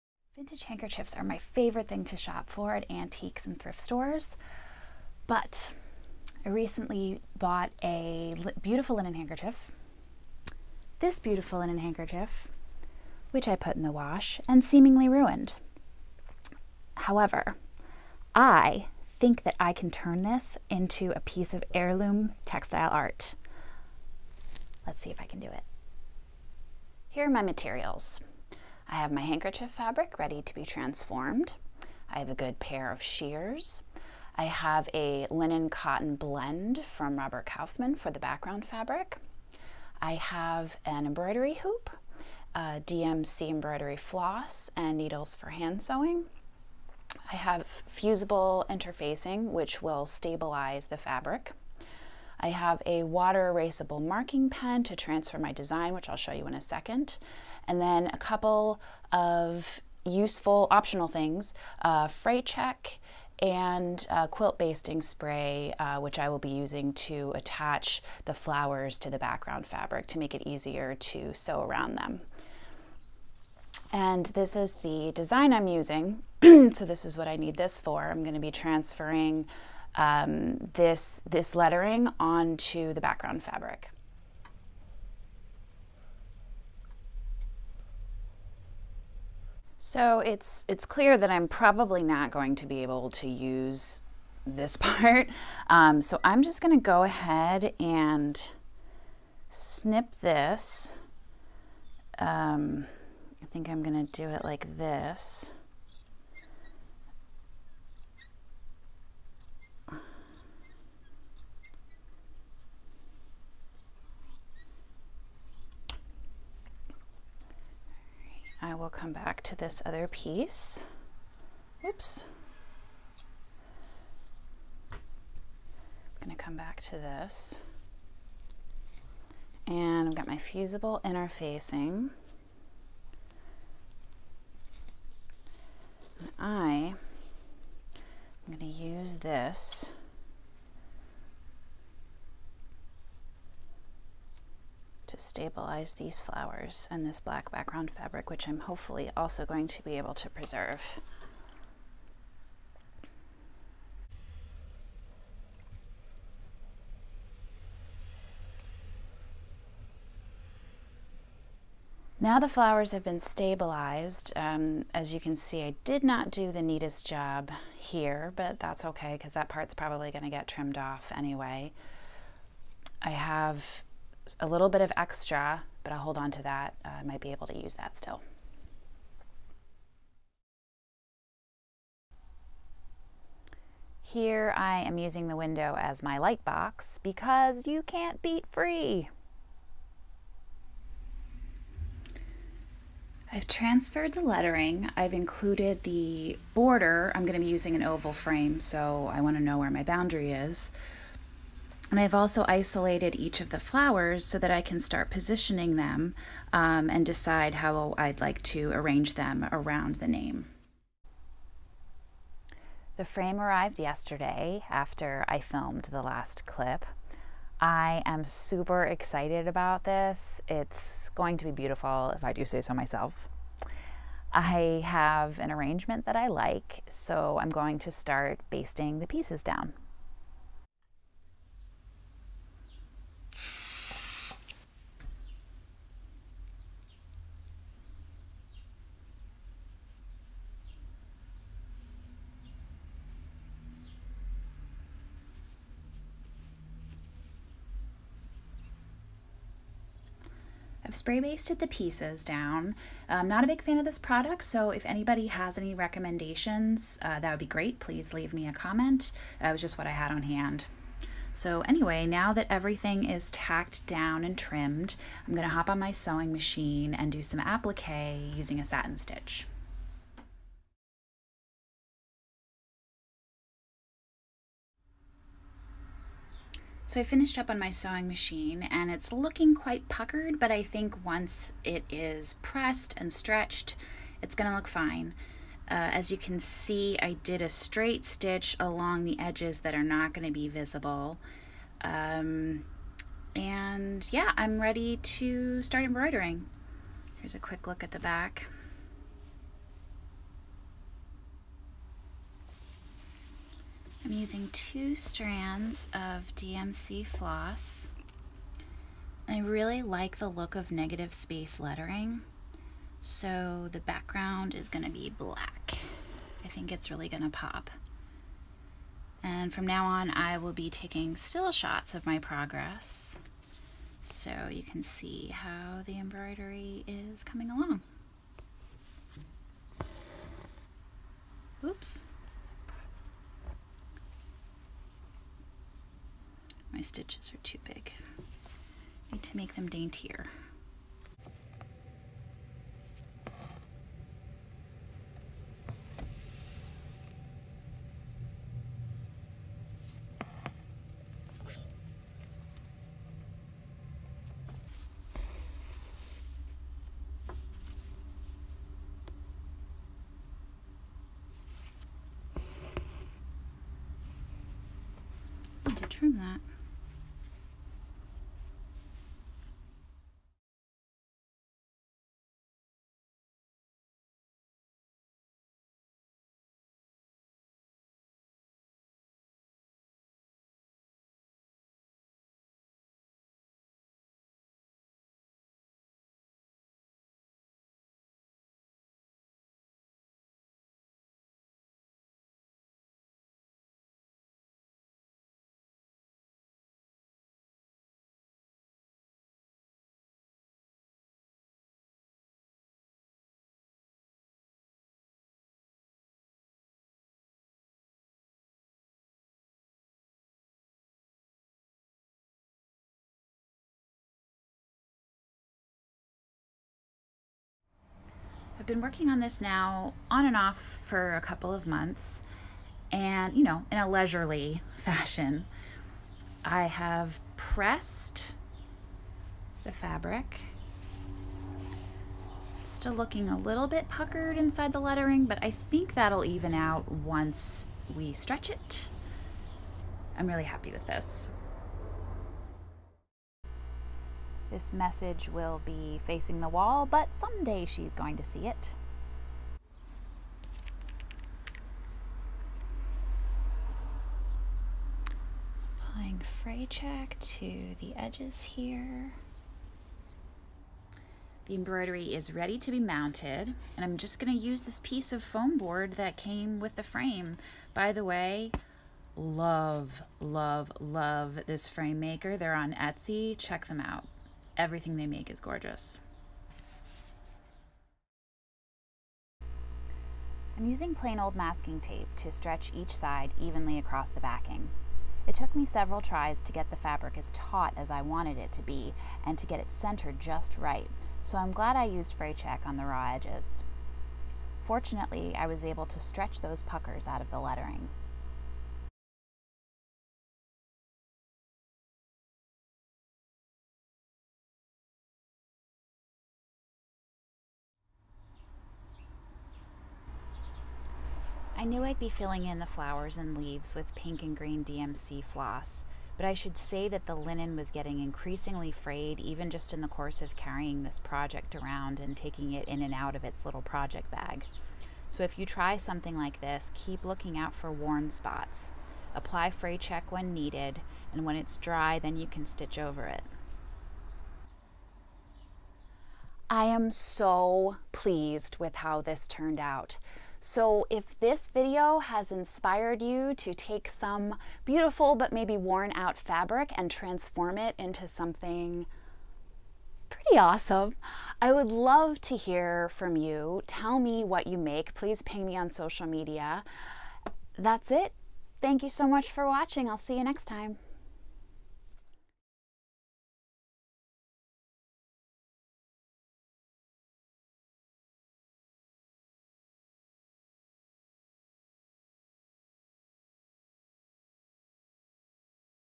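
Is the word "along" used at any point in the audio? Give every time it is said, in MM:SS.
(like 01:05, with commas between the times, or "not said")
04:48, 05:27.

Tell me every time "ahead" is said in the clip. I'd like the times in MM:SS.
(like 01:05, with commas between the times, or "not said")
01:37.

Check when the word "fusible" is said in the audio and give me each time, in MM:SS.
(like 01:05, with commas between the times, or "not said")
00:47, 02:10.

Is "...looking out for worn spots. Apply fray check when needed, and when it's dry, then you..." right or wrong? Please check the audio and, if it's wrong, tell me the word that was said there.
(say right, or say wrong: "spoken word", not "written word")
right.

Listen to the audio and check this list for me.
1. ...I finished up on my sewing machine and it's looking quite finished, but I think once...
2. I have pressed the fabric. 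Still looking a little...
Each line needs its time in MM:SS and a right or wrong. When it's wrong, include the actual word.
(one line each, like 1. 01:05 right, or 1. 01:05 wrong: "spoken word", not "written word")
1. 04:36 wrong: "puckered", not "finished"
2. 07:06 right.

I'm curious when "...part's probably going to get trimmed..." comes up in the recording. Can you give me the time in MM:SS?
02:49.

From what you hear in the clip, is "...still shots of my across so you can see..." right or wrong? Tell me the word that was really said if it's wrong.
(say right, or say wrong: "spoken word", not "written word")
wrong: "progress", not "across".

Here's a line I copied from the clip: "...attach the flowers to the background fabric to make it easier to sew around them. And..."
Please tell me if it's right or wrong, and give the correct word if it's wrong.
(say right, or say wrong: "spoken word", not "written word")
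right.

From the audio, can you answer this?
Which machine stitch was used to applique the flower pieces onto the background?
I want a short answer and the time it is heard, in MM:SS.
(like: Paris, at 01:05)
satin stitch, at 04:28.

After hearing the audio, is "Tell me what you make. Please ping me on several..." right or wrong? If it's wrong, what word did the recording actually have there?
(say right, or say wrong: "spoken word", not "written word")
wrong: "social", not "several".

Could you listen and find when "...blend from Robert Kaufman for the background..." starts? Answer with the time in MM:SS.
00:36.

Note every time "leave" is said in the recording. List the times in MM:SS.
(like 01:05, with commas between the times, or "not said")
04:18, 08:33.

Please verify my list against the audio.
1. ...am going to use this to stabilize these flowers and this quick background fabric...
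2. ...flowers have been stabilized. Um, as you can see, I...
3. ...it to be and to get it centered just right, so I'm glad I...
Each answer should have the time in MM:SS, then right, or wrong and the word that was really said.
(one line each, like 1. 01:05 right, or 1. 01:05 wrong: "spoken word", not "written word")
1. 02:16 wrong: "black", not "quick"
2. 02:42 right
3. 08:08 right.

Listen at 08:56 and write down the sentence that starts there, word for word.
I am so pleased with how this turned out.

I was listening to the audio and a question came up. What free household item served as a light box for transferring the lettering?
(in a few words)
the window.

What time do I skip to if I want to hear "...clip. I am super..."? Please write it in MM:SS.
03:36.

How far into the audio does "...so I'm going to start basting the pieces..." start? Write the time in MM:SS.
03:46.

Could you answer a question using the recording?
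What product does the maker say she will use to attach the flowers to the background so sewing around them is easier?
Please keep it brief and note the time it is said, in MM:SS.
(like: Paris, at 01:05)
quilt basting spray, at 01:04.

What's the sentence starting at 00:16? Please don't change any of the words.
However, I think that I can turn this into a piece of heirloom textile art.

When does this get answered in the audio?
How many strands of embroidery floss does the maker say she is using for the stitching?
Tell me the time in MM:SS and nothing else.
05:04.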